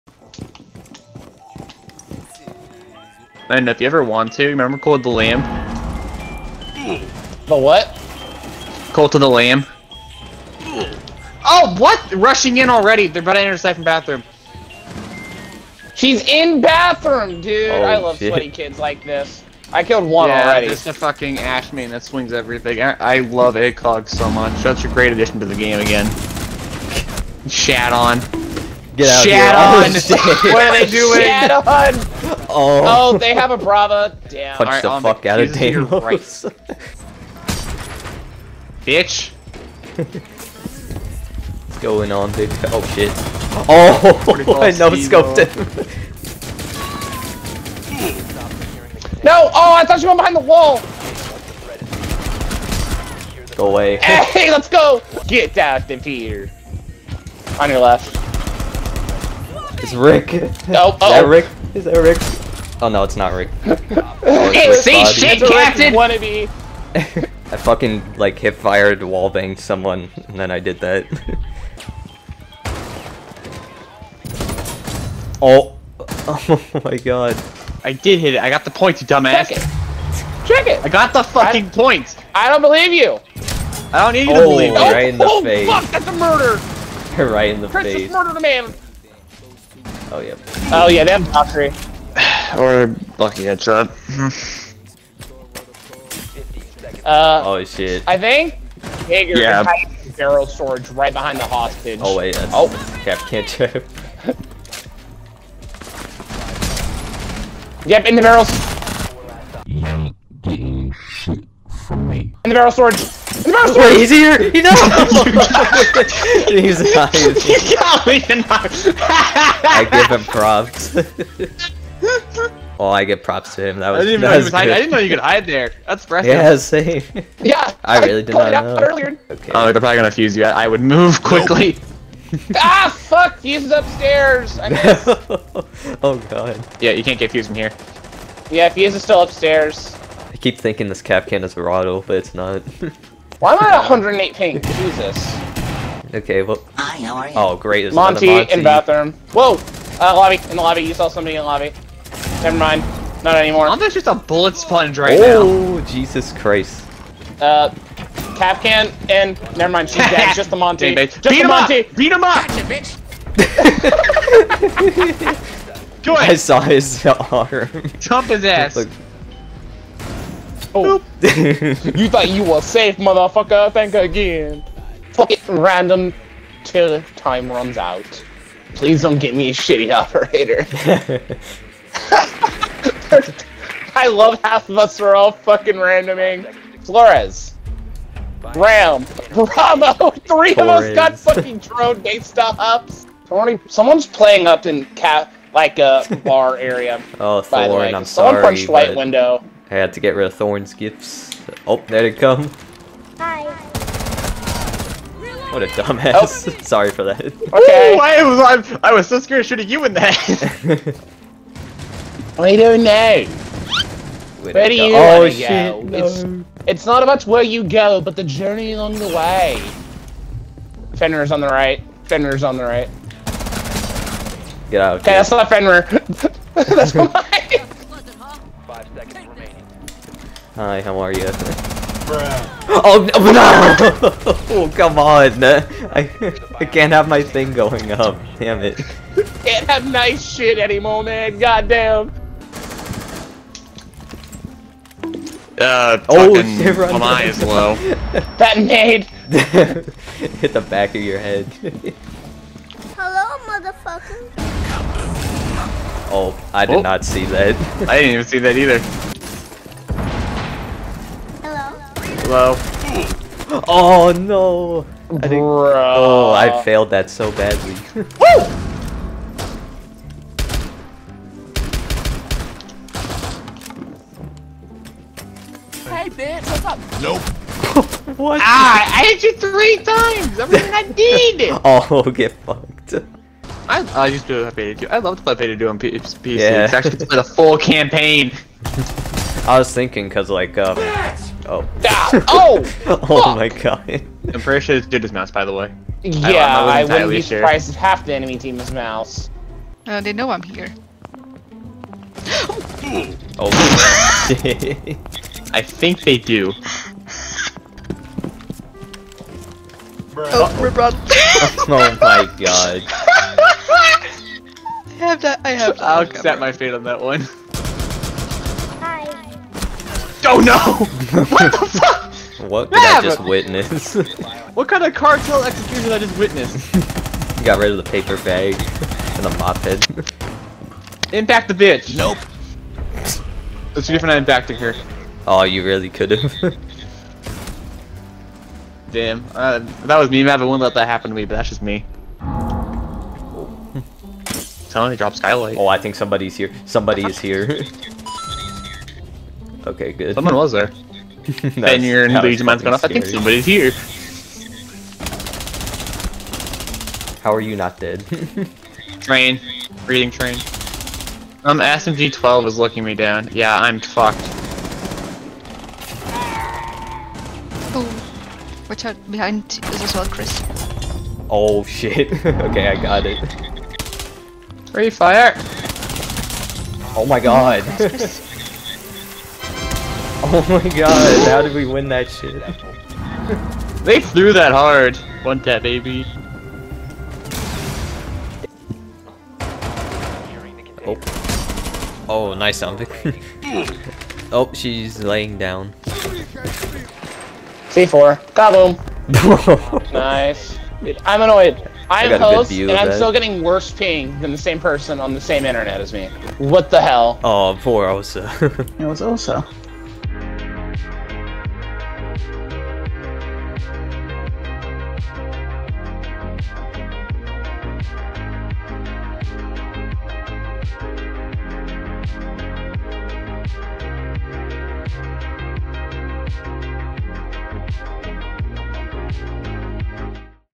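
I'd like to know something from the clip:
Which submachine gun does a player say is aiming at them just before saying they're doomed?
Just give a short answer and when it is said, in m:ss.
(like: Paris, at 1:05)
SMG-12, at 6:01.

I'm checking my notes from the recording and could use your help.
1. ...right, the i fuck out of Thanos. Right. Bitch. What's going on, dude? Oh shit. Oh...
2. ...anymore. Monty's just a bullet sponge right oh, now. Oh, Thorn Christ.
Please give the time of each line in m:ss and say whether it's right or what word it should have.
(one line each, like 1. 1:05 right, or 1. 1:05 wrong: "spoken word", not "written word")
1. 0:34 right
2. 2:33 wrong: "Jesus", not "Thorn".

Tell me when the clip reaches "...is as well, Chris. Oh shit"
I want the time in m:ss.
6:09.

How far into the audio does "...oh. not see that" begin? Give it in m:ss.
4:16.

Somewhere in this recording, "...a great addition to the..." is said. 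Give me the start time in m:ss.
0:24.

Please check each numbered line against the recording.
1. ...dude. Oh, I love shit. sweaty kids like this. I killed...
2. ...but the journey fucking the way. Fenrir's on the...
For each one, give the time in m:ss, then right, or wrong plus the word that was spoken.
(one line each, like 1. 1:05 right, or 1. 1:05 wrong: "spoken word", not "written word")
1. 0:17 right
2. 3:38 wrong: "along", not "fucking".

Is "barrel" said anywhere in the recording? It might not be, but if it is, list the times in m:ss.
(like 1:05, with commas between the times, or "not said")
1:40, 1:48, 1:52.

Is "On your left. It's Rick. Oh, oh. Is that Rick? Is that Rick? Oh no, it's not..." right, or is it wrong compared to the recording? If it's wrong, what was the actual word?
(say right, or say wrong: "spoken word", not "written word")
right.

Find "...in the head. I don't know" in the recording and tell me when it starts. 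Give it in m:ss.
3:29.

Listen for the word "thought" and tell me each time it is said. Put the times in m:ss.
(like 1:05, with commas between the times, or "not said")
0:49, 2:52.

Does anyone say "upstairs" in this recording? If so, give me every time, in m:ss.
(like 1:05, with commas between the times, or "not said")
2:13, 2:19.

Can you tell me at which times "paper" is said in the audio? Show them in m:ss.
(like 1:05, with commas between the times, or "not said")
5:27.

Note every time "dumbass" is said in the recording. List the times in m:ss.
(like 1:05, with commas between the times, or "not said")
1:19, 3:25.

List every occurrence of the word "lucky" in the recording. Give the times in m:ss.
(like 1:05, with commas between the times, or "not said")
1:33.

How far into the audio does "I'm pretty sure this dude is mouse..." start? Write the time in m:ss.
4:54.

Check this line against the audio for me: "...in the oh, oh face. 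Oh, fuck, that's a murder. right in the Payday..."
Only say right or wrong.
wrong.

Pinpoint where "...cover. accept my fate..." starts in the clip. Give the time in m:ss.
5:16.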